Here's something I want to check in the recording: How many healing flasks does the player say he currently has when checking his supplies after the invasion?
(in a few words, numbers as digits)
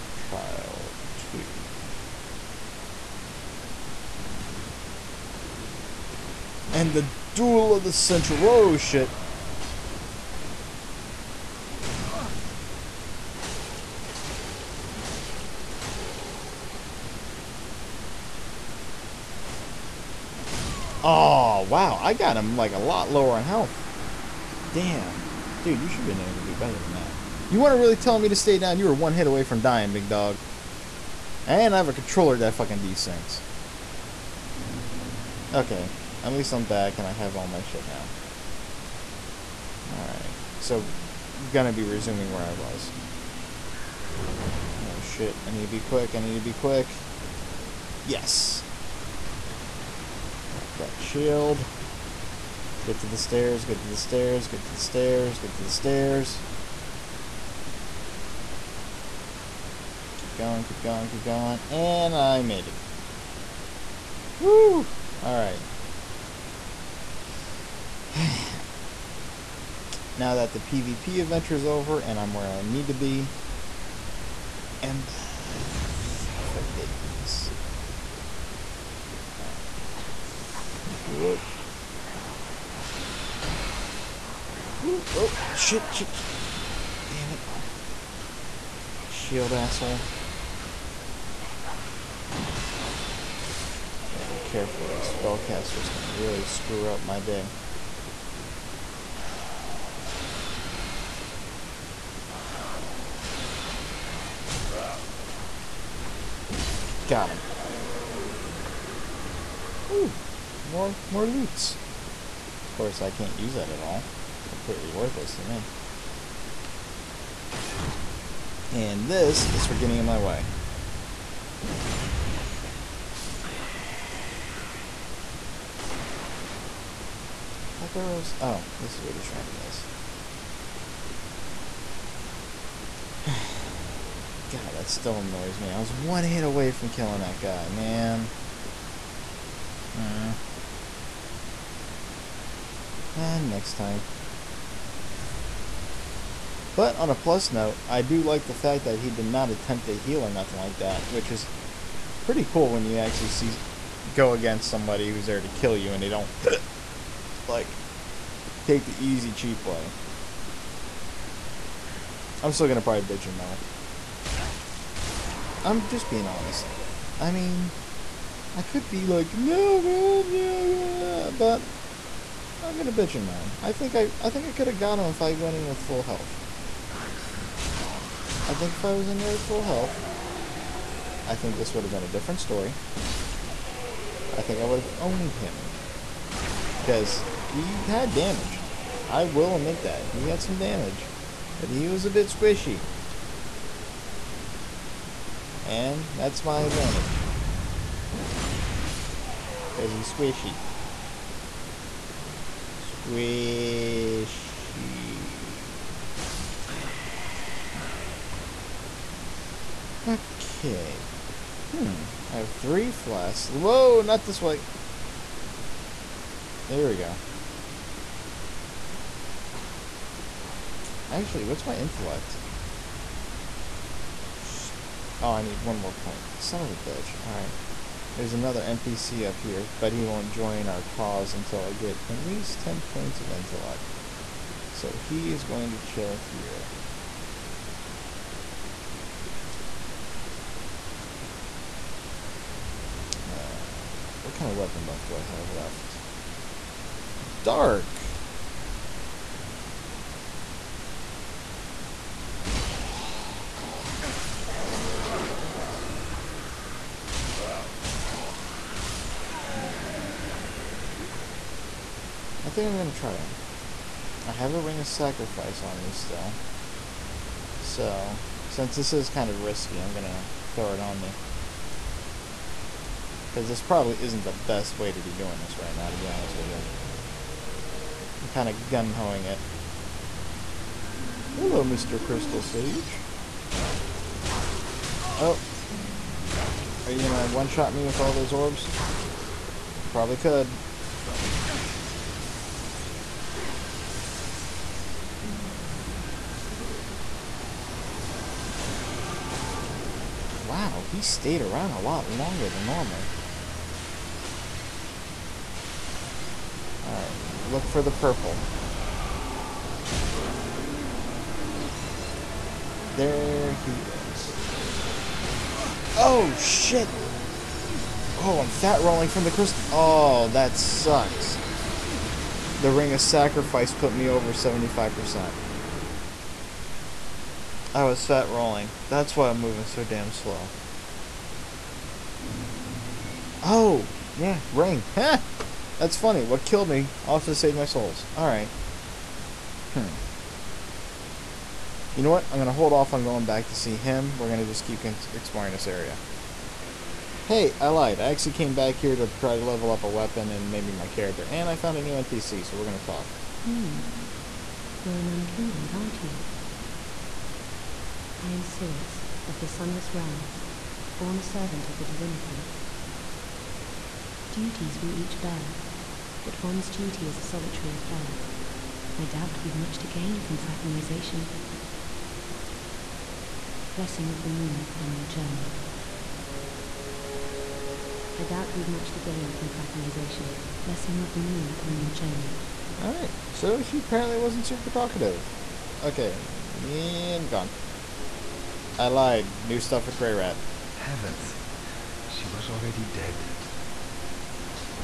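3.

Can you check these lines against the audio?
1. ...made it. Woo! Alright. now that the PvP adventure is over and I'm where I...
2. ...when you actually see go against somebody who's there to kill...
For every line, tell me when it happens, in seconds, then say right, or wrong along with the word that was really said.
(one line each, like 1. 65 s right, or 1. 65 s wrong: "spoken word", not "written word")
1. 62 s right
2. 152 s right.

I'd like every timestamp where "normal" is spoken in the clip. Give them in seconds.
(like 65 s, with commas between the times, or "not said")
302 s.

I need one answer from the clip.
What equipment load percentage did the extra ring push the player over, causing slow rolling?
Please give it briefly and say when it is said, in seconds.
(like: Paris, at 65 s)
75%, at 324 s.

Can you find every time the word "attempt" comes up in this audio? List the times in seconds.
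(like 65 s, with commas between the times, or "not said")
149 s.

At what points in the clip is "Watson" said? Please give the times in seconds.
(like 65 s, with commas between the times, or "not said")
not said.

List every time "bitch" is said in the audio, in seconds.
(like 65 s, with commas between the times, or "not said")
163 s, 172 s, 226 s.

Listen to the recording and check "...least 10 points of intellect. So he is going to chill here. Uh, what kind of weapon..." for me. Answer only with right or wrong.
right.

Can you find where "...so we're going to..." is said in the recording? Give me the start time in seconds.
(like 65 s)
352 s.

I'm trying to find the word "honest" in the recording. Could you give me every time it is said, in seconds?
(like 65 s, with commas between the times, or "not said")
166 s, 276 s.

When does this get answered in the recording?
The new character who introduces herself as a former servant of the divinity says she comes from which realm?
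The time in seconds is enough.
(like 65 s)
359 s.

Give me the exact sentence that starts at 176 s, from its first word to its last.
I think if I was in there with full health, I think this would have been a different story.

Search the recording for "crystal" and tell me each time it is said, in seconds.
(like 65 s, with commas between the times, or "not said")
282 s, 319 s.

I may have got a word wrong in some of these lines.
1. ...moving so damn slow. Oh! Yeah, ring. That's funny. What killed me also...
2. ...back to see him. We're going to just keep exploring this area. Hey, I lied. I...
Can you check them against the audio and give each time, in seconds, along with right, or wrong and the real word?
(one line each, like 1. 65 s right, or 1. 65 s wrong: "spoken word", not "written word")
1. 329 s right
2. 343 s right.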